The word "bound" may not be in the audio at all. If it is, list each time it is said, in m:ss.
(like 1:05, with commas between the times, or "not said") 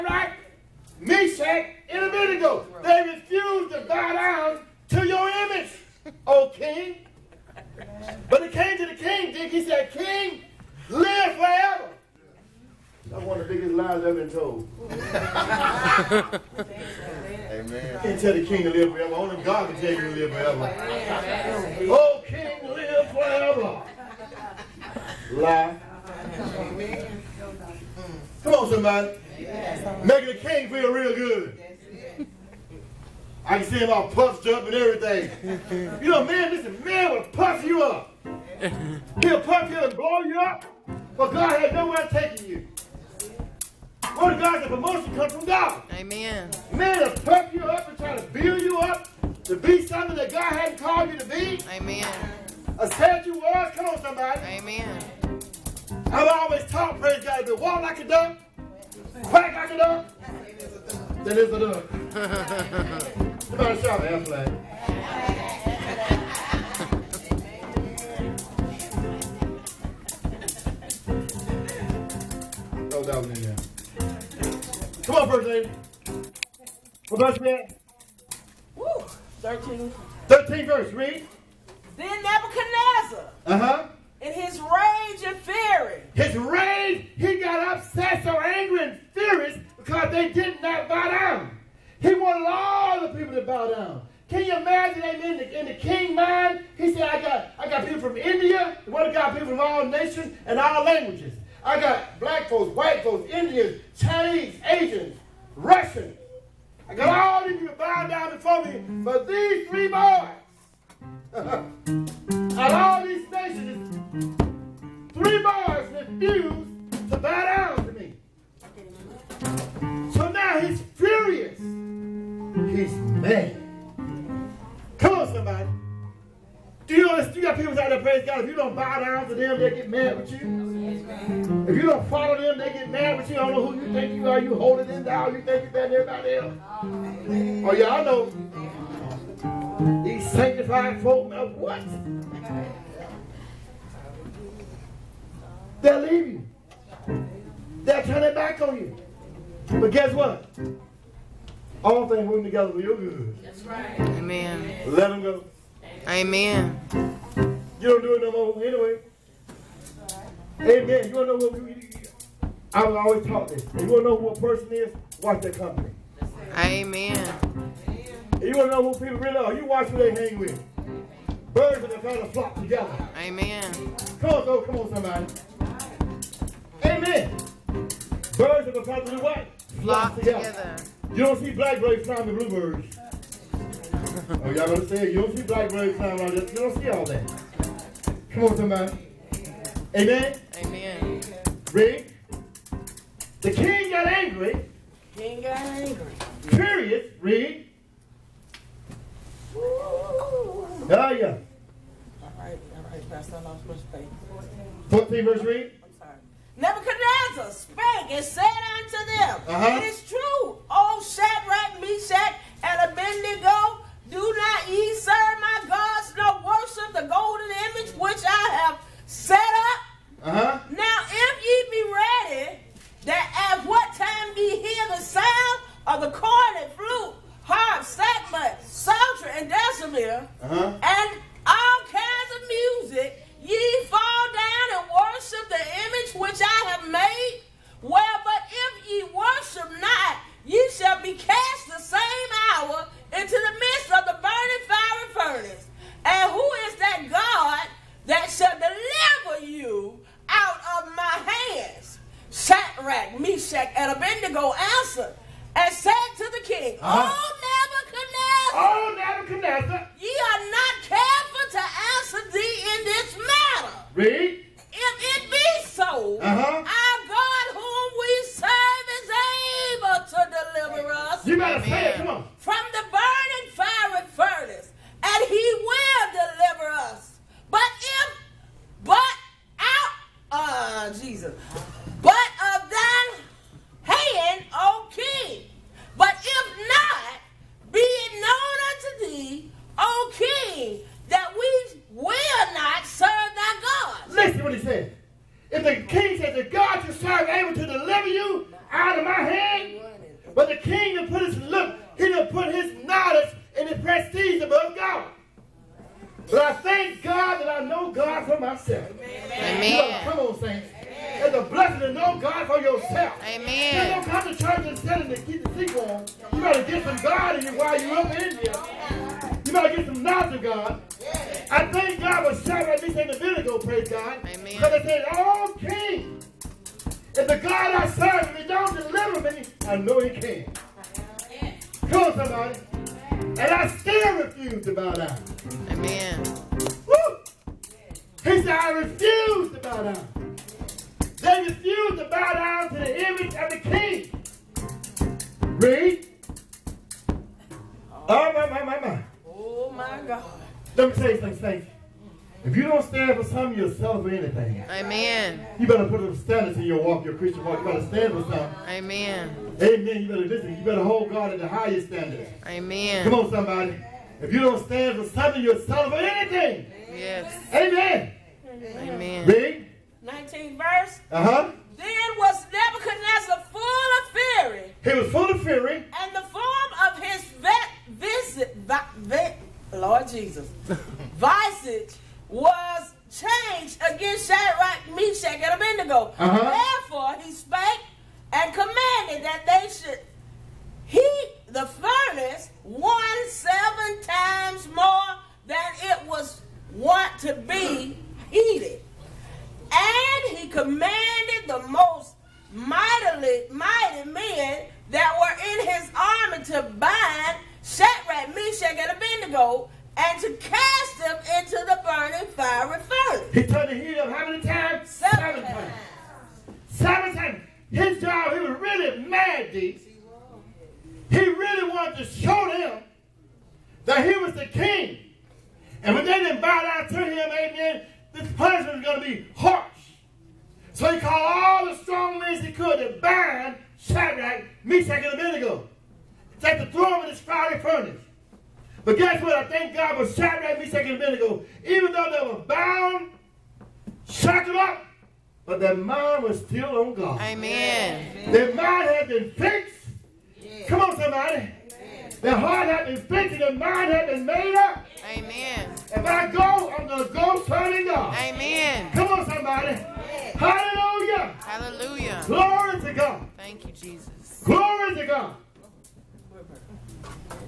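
7:22.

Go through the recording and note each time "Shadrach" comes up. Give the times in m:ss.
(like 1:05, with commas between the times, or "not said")
3:31, 6:24, 6:47, 7:13, 7:20.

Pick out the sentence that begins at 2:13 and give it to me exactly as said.
I don't know who you think you are.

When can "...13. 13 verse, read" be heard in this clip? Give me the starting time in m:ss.
1:19.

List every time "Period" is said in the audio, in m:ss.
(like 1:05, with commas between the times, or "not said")
3:16.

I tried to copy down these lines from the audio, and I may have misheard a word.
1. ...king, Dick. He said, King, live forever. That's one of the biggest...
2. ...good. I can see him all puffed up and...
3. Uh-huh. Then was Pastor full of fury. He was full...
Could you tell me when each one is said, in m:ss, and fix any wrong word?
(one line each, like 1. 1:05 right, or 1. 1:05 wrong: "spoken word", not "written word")
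1. 0:08 right
2. 0:31 right
3. 6:11 wrong: "Nebuchadnezzar", not "Pastor".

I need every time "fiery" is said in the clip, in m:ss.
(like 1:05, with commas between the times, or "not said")
6:52, 7:17.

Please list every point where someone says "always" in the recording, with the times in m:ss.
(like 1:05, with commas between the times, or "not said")
0:56, 2:42.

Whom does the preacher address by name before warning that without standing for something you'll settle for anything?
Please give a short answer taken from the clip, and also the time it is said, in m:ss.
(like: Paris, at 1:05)
Stacey, at 5:51.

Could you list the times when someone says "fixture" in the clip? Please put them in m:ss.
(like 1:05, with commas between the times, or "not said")
not said.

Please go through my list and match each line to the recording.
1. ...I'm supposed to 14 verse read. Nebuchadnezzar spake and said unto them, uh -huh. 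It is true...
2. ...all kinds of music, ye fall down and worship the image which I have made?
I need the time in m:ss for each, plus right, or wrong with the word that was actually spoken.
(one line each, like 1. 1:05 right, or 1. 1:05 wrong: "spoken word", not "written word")
1. 3:23 right
2. 3:51 right.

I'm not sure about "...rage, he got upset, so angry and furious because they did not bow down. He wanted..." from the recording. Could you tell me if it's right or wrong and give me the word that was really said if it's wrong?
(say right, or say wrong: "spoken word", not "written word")
right.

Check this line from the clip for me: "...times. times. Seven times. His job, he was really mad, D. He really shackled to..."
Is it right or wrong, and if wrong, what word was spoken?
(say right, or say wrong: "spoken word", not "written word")
wrong: "wanted", not "shackled".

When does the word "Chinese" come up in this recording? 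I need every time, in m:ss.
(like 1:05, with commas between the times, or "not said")
1:43.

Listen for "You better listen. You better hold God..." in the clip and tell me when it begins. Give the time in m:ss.
6:00.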